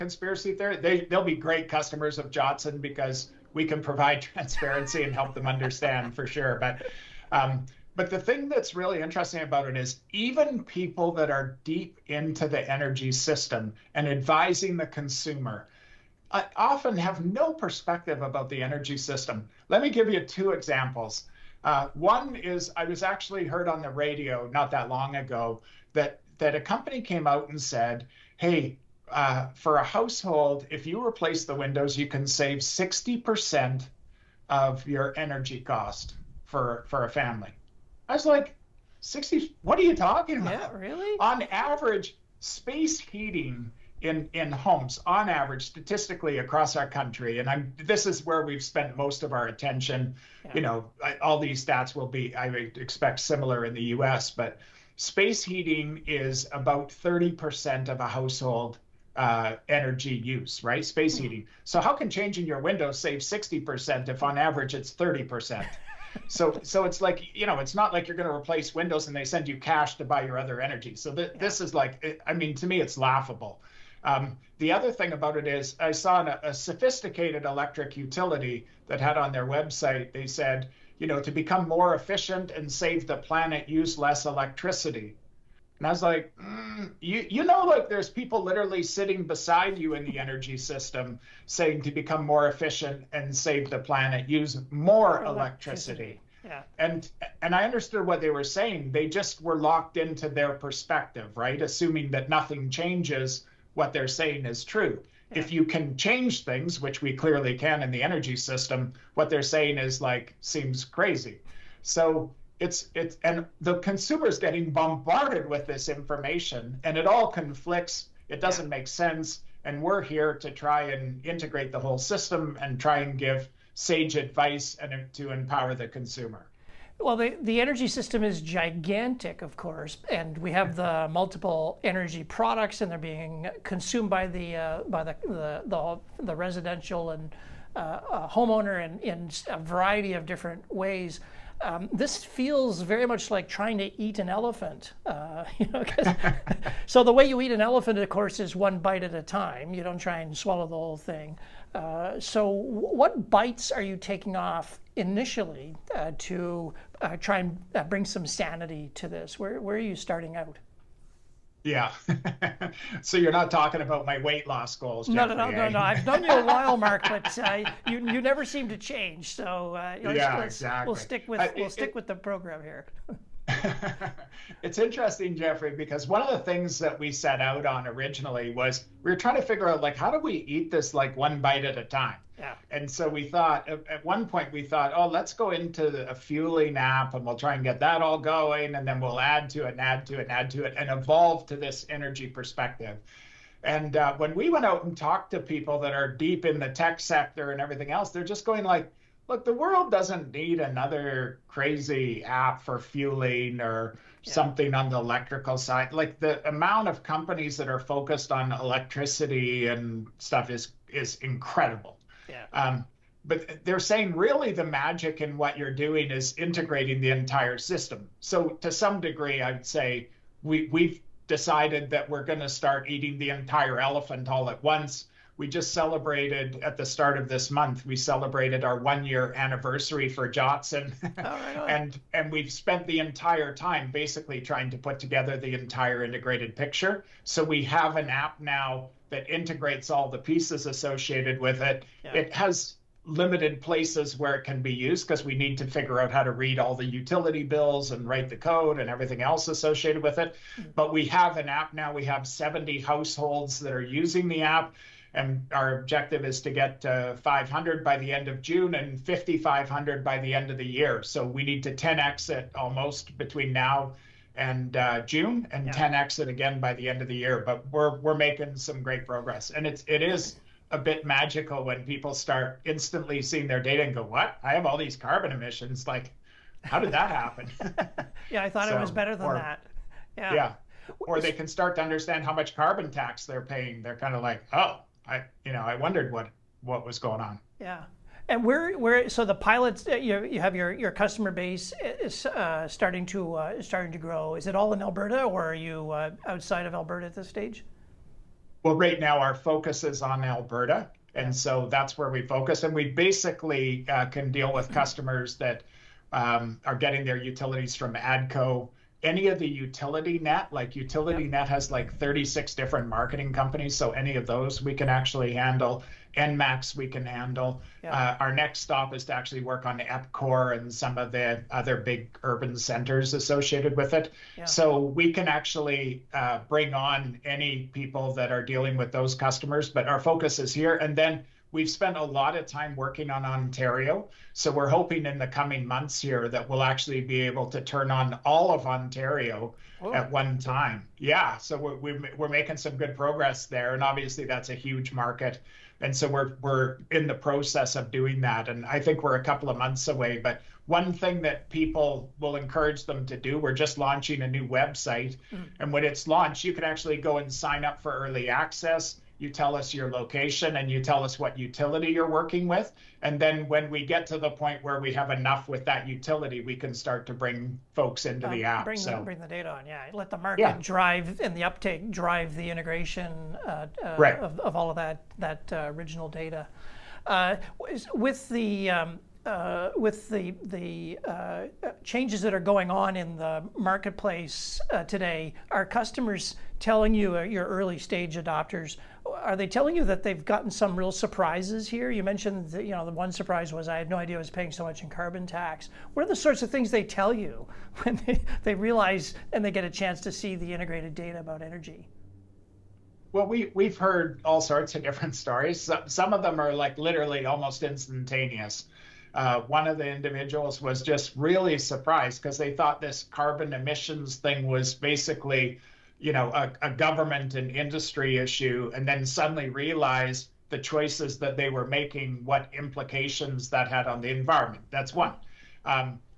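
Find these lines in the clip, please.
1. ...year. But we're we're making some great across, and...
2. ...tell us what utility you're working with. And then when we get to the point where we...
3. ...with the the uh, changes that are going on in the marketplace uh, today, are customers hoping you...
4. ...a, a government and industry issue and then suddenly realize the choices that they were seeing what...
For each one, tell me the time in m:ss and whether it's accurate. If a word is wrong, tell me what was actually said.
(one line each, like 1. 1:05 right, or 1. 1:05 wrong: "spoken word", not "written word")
1. 4:27 wrong: "progress", not "across"
2. 6:00 right
3. 6:19 wrong: "telling", not "hoping"
4. 6:56 wrong: "making", not "seeing".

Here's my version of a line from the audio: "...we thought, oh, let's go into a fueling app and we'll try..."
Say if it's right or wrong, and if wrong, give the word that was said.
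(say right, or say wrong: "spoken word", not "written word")
right.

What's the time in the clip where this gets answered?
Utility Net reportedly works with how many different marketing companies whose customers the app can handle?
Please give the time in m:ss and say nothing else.
5:11.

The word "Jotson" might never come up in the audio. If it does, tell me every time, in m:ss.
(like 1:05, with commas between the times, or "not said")
0:02, 3:50.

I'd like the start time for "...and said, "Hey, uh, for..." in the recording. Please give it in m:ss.
0:27.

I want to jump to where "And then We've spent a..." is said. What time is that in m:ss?
5:30.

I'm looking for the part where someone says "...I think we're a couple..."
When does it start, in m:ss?
5:48.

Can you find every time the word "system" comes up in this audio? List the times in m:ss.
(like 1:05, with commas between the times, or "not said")
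0:13, 0:18, 1:30, 1:48, 2:01, 2:07, 3:37.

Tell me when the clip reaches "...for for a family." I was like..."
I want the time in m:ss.
0:36.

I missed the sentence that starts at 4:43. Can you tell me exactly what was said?
They're kind of like, "Oh, I you know I wondered what what was going on.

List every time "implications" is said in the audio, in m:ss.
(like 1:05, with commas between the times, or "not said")
7:02.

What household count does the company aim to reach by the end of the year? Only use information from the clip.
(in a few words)
5,500.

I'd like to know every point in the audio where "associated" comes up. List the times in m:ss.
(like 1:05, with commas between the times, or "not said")
4:00, 4:09, 5:23.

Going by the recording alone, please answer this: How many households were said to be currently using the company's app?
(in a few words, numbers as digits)
70.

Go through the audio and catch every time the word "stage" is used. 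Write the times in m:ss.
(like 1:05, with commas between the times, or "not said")
4:57, 6:27.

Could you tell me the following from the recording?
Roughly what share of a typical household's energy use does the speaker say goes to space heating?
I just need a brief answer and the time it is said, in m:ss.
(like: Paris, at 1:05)
30%, at 0:56.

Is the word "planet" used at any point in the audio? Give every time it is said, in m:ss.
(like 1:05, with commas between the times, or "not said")
1:23, 1:33.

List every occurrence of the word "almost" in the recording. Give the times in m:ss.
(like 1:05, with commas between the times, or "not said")
4:22, 6:47.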